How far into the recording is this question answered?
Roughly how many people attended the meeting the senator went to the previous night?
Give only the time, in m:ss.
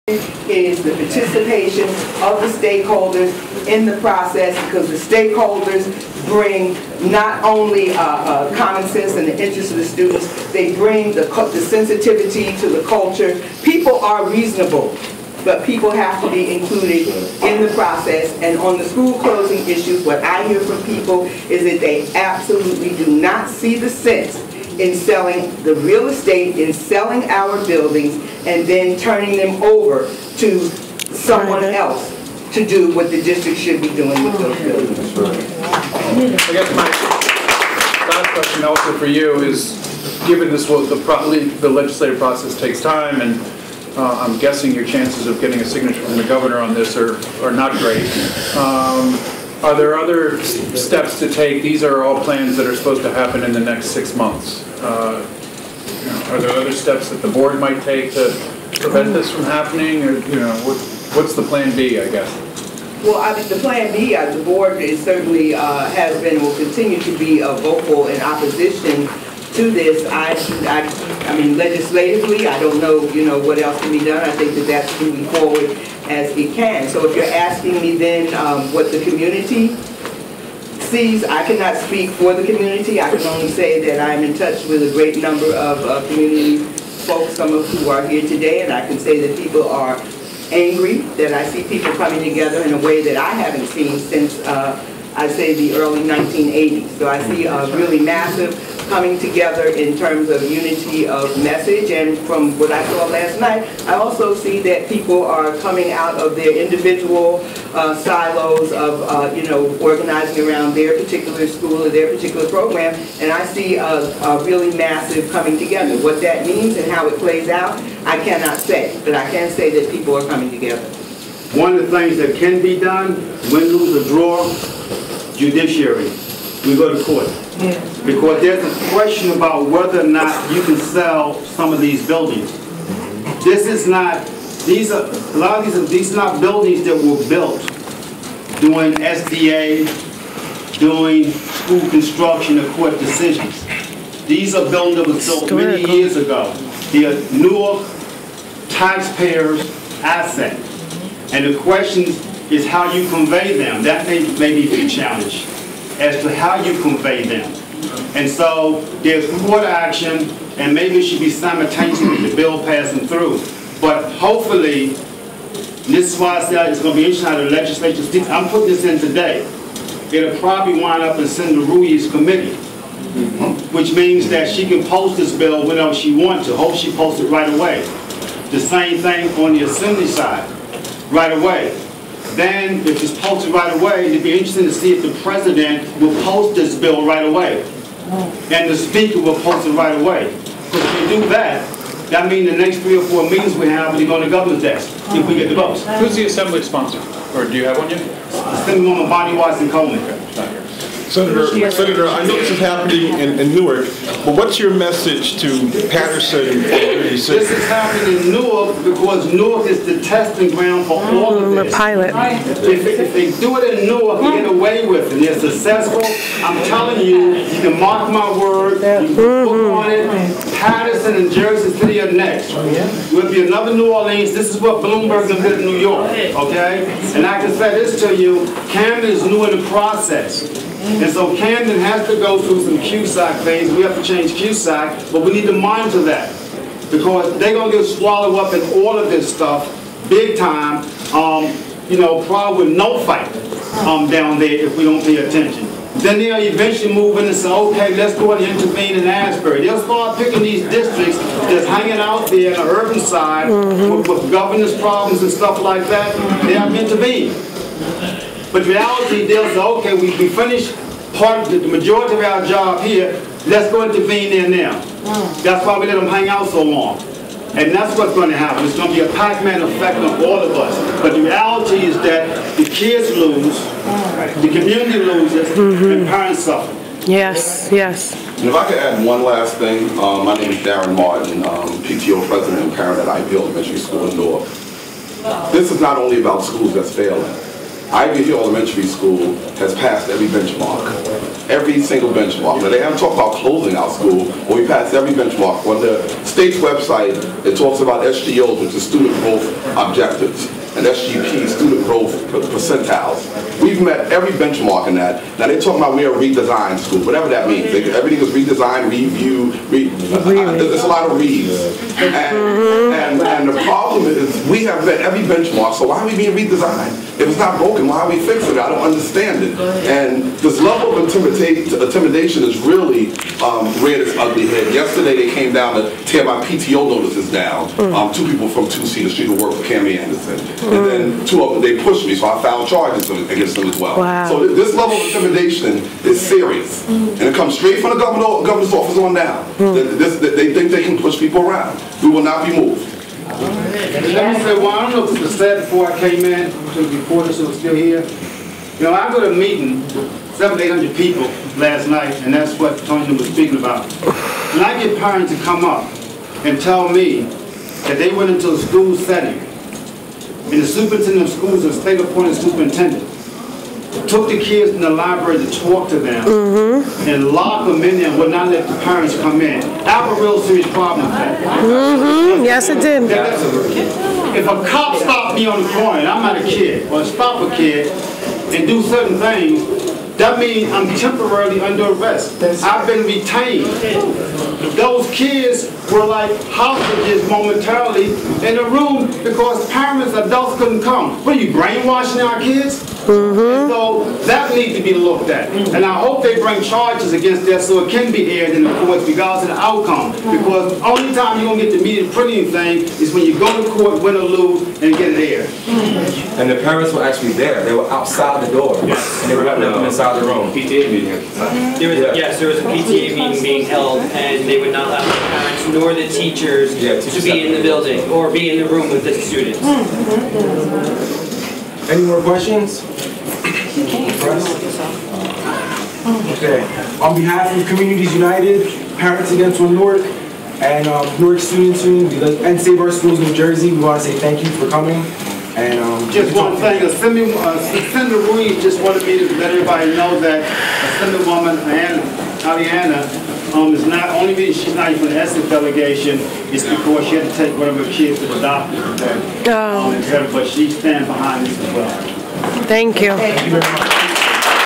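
5:50.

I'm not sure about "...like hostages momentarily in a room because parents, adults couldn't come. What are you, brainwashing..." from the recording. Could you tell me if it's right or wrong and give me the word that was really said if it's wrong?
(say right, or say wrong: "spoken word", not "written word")
right.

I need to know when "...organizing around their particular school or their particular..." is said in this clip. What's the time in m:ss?
1:49.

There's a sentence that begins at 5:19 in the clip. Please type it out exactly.
And this level of intimidation is really um, reared its ugly head.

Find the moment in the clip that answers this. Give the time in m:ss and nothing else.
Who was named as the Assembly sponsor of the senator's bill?
3:19.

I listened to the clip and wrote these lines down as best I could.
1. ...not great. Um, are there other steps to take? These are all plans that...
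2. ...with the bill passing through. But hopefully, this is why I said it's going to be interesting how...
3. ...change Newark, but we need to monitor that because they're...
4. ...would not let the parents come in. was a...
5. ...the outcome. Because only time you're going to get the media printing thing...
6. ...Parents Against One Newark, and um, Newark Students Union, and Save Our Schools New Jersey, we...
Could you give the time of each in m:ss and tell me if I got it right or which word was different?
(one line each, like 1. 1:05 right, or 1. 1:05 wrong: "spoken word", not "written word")
1. 0:47 right
2. 2:42 right
3. 3:54 wrong: "QSAC", not "Newark"
4. 6:08 right
5. 6:39 right
6. 7:08 right.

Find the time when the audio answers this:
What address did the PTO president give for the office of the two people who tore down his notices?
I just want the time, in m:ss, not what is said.
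5:28.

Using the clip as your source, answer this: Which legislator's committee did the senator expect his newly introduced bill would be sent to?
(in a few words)
Ruiz.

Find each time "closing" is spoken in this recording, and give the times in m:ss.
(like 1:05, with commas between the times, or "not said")
0:19, 4:53.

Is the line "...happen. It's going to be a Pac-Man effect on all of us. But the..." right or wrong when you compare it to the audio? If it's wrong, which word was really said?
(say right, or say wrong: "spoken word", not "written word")
right.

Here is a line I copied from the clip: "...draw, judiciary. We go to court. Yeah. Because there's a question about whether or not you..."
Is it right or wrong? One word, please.
right.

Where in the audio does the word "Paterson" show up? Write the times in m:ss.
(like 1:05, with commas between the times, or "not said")
3:25, 3:40.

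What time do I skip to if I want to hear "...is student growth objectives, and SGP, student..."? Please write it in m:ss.
4:58.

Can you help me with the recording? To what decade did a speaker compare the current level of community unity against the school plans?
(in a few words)
early 1980s.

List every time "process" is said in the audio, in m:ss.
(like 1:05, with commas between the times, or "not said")
0:03, 0:17, 0:42, 3:49.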